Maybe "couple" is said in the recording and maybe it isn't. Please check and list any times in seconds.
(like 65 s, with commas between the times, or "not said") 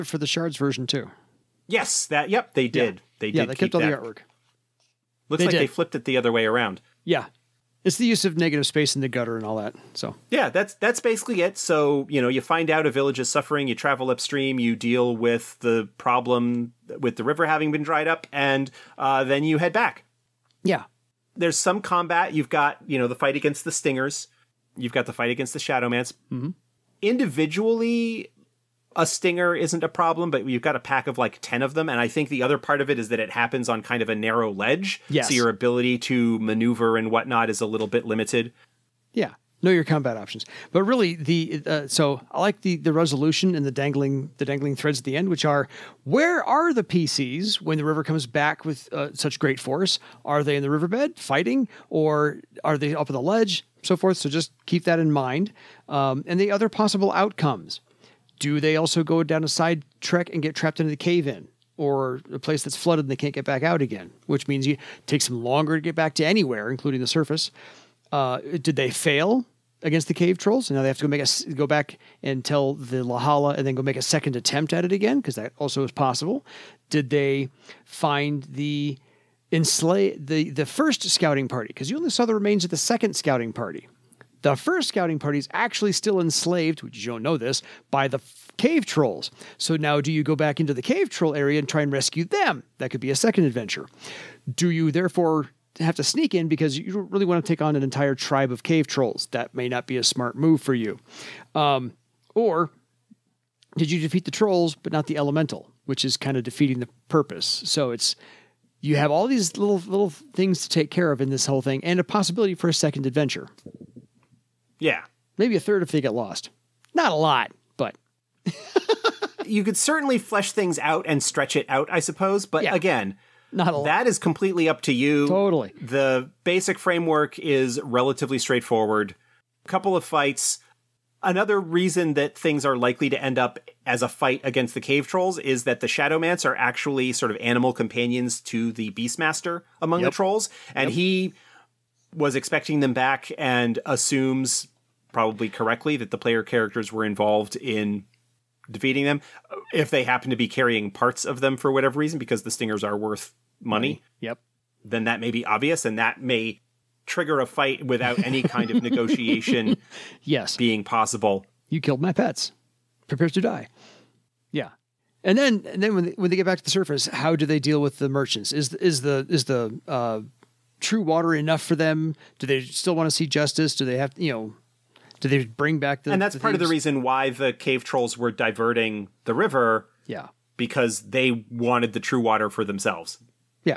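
129 s.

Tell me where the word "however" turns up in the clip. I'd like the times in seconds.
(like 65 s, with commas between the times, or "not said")
not said.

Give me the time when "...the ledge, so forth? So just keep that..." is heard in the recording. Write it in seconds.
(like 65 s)
53 s.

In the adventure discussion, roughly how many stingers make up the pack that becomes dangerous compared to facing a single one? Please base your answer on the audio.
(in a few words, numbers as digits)
10.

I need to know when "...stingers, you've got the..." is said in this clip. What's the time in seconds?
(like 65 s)
23 s.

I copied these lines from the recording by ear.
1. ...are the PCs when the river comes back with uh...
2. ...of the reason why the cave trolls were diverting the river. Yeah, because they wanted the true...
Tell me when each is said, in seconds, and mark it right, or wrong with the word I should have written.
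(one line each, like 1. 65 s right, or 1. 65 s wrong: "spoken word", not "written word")
1. 46 s right
2. 176 s right.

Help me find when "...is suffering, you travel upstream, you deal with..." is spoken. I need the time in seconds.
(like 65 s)
13 s.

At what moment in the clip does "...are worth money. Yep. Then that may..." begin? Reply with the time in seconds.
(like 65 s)
152 s.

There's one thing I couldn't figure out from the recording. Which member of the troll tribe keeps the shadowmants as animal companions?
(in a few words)
the Beastmaster.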